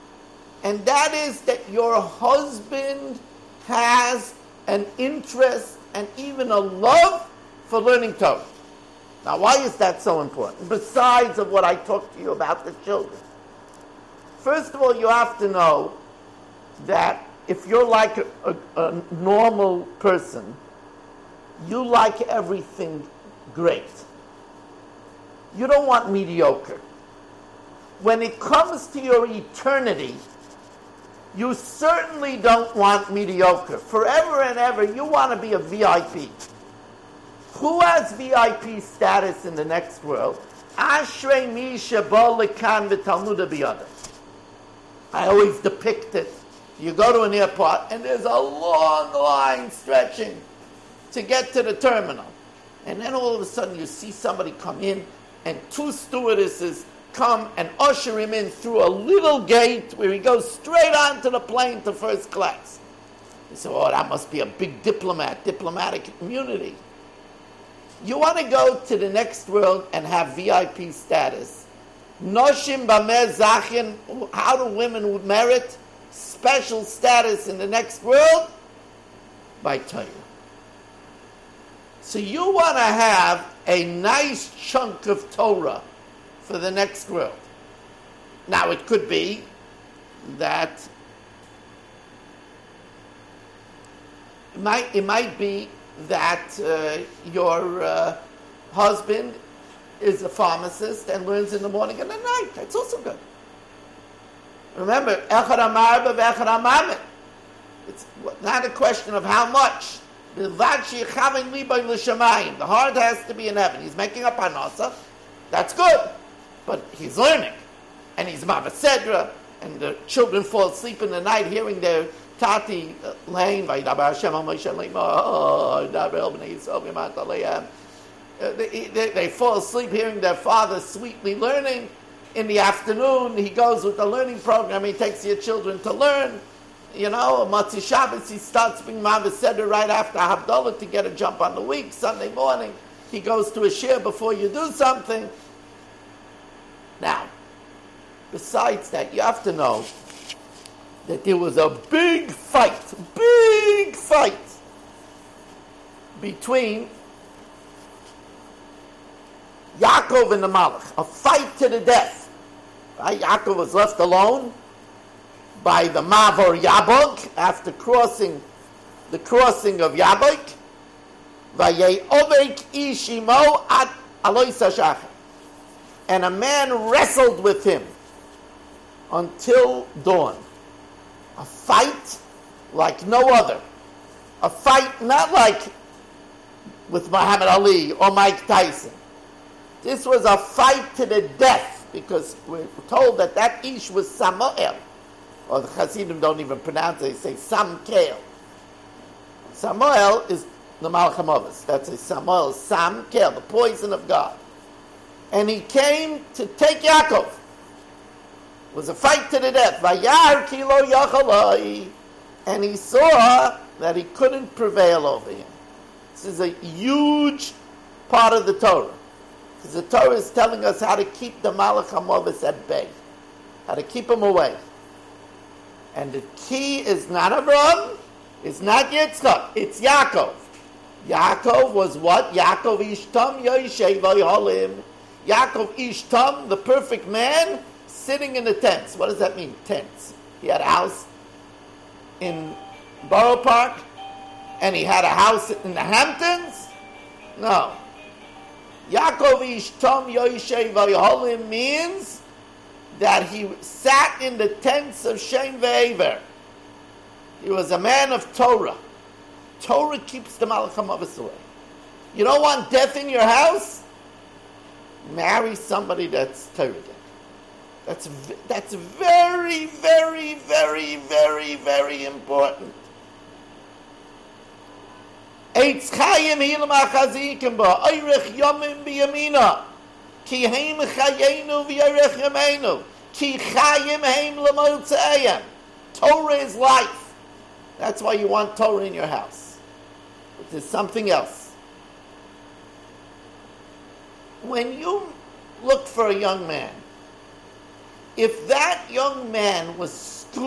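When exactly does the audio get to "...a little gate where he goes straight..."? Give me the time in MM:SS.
00:58.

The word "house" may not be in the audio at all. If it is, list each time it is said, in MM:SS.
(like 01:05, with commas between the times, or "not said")
04:00, 04:05, 04:23, 04:49.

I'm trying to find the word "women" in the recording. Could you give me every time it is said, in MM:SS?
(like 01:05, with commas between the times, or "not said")
01:14.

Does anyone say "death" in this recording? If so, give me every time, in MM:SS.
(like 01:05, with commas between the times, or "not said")
02:41, 03:11, 03:29, 04:22.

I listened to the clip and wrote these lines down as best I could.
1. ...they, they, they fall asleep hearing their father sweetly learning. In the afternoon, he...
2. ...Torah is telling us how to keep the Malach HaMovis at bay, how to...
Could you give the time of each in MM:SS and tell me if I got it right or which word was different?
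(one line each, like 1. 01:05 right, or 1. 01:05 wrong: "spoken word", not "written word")
1. 02:08 right
2. 03:39 right.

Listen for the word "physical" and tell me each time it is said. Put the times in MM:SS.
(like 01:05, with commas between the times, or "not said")
not said.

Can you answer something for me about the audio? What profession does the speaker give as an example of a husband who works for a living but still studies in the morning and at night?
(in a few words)
pharmacist.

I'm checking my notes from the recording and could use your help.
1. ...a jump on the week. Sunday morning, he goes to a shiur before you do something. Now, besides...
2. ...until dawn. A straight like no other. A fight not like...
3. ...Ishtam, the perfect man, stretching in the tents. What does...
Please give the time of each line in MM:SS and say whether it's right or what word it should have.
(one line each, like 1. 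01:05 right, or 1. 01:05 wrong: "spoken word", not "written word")
1. 02:21 right
2. 02:59 wrong: "fight", not "straight"
3. 03:55 wrong: "sitting", not "stretching".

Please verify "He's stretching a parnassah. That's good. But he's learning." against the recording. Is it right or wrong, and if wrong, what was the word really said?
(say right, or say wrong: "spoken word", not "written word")
wrong: "making", not "stretching".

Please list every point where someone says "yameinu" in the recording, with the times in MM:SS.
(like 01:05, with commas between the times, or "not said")
04:42.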